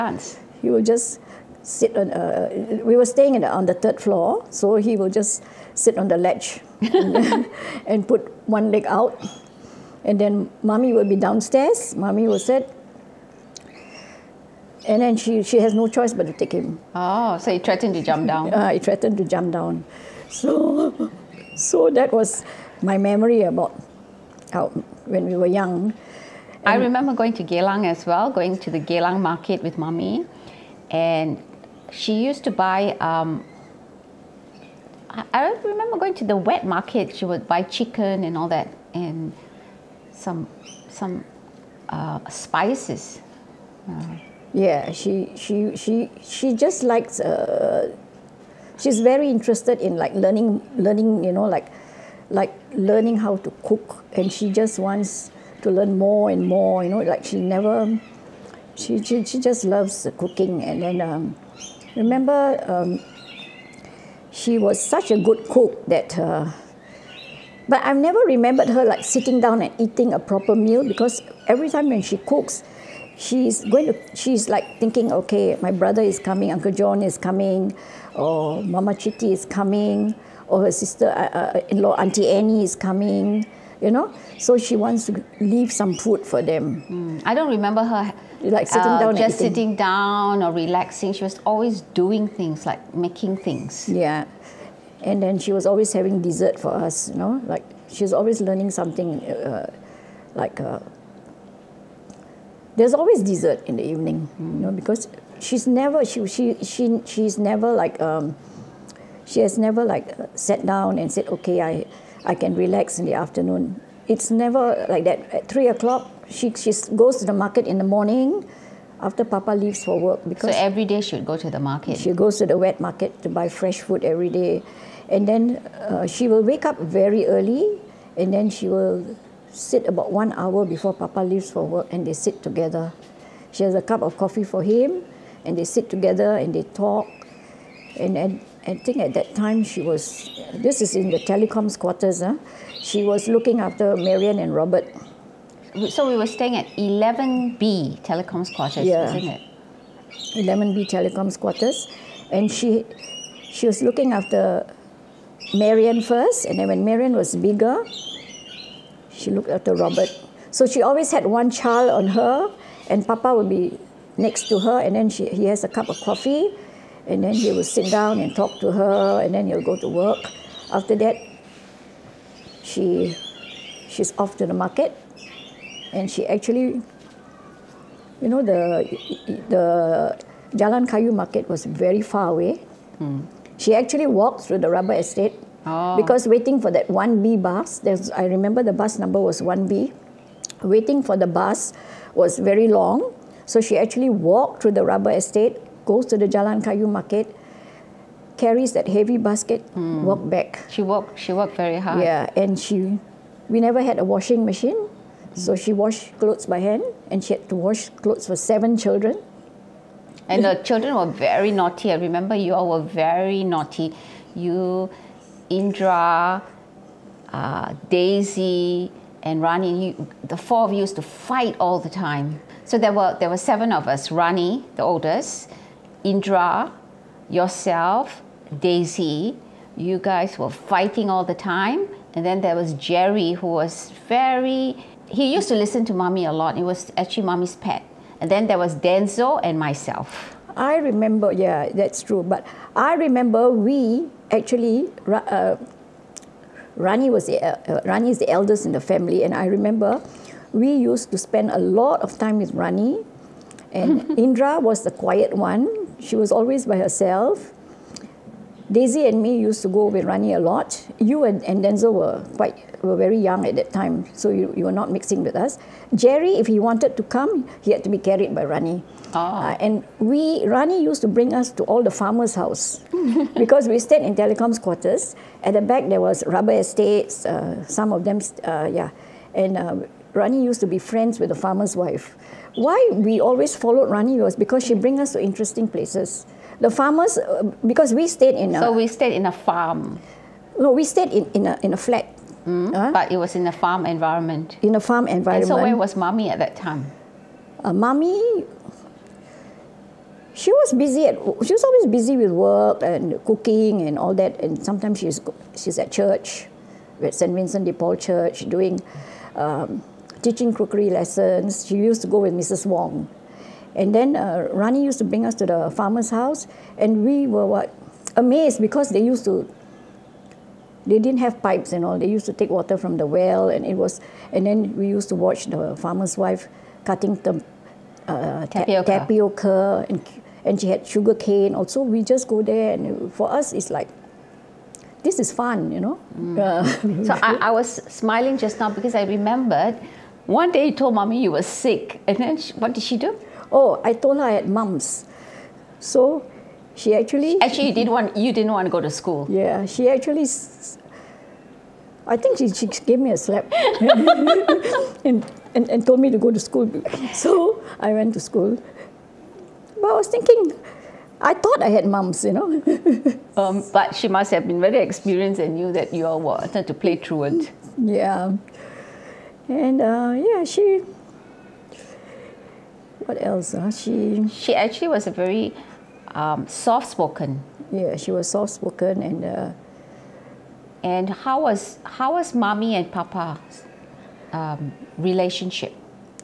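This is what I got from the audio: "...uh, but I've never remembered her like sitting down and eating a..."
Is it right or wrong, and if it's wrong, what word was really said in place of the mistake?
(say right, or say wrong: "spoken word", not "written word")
right.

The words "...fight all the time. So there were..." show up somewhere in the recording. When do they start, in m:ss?
3:41.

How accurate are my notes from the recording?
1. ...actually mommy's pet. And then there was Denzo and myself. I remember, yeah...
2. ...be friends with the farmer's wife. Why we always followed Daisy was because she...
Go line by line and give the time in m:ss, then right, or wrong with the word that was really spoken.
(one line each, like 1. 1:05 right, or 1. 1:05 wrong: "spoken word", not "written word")
1. 3:56 right
2. 4:40 wrong: "Rani", not "Daisy".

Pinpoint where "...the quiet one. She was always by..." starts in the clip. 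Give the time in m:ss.
4:14.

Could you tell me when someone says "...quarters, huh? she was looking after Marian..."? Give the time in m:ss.
2:21.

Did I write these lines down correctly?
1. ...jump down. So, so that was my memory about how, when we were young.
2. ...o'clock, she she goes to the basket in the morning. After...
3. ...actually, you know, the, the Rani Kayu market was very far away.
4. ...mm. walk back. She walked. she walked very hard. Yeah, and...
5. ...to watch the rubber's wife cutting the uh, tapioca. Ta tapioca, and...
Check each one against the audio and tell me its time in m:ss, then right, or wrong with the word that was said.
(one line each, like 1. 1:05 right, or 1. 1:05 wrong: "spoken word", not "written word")
1. 0:19 right
2. 1:55 wrong: "market", not "basket"
3. 2:56 wrong: "Jalan", not "Rani"
4. 3:19 right
5. 5:25 wrong: "farmer", not "rubber".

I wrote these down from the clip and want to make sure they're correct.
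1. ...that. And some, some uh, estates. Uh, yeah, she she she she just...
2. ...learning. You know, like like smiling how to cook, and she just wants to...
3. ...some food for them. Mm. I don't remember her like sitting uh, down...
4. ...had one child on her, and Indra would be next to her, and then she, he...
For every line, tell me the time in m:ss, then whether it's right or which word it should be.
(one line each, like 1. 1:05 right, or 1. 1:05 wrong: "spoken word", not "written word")
1. 0:38 wrong: "spices", not "estates"
2. 0:50 wrong: "learning", not "smiling"
3. 1:25 right
4. 2:41 wrong: "Papa", not "Indra".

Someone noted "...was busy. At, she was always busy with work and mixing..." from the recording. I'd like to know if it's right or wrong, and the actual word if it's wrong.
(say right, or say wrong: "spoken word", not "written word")
wrong: "cooking", not "mixing".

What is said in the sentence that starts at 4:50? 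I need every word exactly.
No, we stayed in, in, a, in a flat.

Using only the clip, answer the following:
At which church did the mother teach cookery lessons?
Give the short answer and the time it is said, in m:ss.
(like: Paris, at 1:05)
St. Vincent de Paul Church, at 5:07.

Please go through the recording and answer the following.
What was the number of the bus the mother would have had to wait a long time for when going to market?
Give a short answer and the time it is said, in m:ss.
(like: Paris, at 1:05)
1B, at 3:08.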